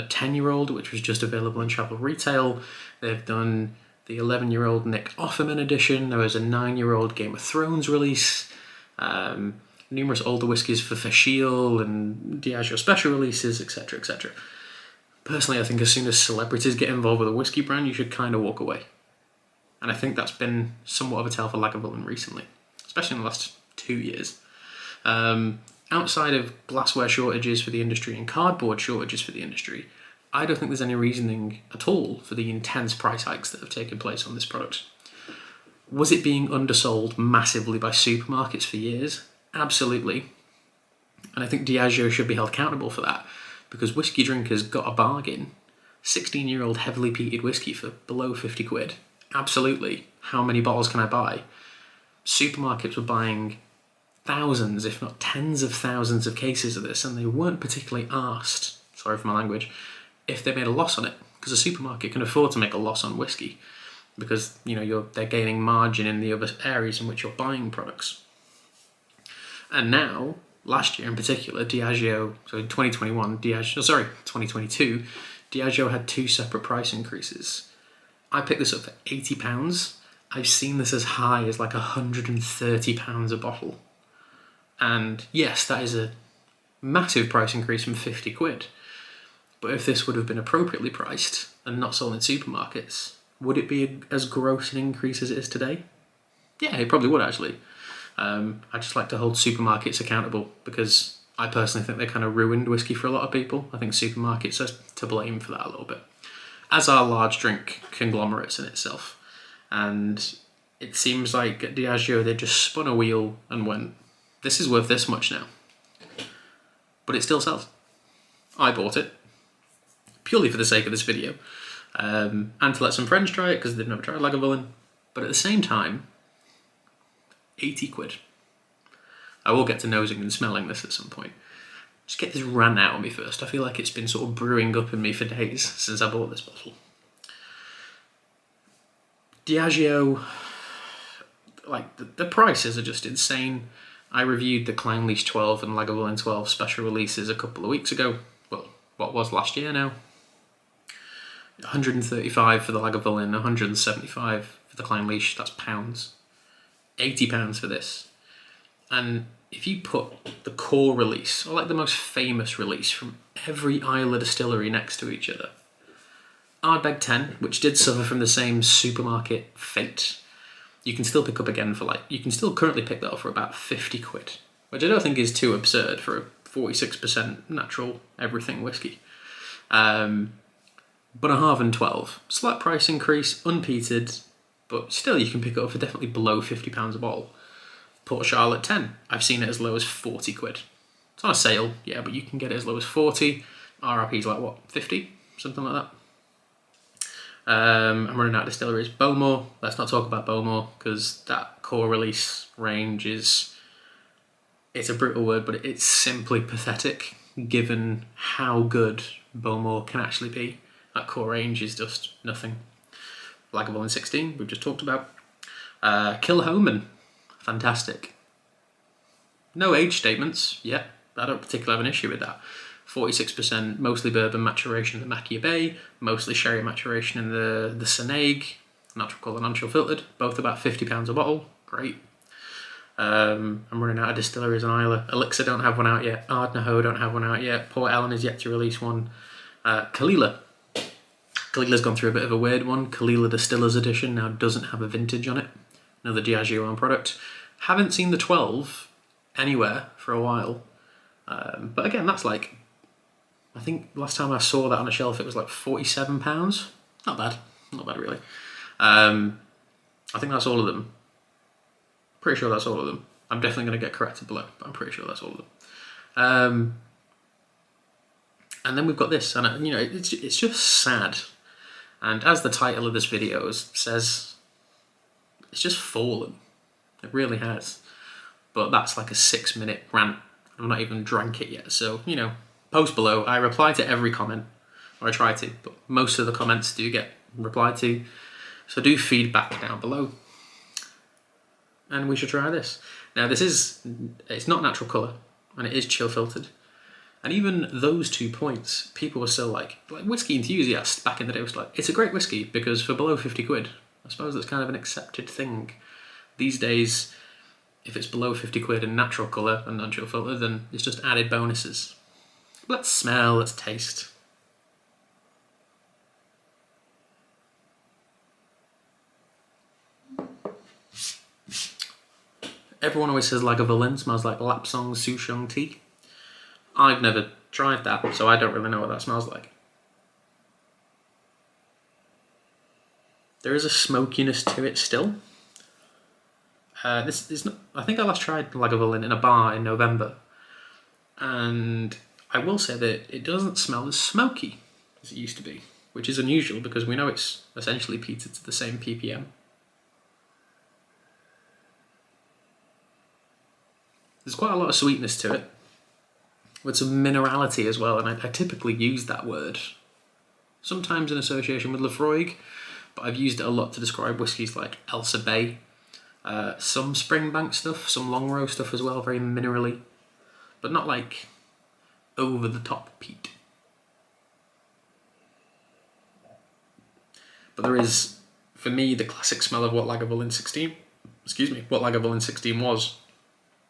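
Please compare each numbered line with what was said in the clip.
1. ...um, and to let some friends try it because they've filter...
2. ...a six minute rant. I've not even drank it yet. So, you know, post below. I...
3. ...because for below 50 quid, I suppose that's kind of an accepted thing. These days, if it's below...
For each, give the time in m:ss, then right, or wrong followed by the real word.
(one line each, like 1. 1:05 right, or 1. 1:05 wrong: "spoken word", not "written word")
1. 2:01 wrong: "never", not "filter"
2. 4:39 right
3. 5:02 right.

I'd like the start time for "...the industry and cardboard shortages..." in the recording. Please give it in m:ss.
0:27.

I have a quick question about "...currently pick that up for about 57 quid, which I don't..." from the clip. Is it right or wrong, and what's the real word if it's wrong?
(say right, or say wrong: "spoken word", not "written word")
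wrong: "50", not "57".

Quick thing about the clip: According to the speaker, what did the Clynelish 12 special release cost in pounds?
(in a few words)
£175.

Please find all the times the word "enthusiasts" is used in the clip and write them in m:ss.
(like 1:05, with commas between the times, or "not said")
5:00.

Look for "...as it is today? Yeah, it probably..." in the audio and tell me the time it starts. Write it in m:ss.
1:35.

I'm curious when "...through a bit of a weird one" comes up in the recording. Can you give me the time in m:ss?
4:01.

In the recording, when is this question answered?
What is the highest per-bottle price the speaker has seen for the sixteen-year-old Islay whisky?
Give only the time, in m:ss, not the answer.
1:21.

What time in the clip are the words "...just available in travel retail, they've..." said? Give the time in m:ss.
0:01.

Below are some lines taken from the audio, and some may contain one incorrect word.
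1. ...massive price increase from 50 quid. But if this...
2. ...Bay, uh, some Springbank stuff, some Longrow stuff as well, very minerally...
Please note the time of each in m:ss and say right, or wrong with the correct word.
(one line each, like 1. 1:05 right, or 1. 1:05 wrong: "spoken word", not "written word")
1. 1:26 right
2. 6:05 right.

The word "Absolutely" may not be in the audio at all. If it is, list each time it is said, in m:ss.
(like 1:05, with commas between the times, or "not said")
0:39, 0:49.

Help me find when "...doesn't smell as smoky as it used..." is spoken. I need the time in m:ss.
5:43.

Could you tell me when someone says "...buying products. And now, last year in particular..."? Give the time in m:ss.
1:07.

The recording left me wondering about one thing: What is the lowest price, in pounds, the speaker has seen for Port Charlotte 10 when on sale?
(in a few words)
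£40.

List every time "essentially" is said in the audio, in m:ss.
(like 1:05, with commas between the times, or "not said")
5:47.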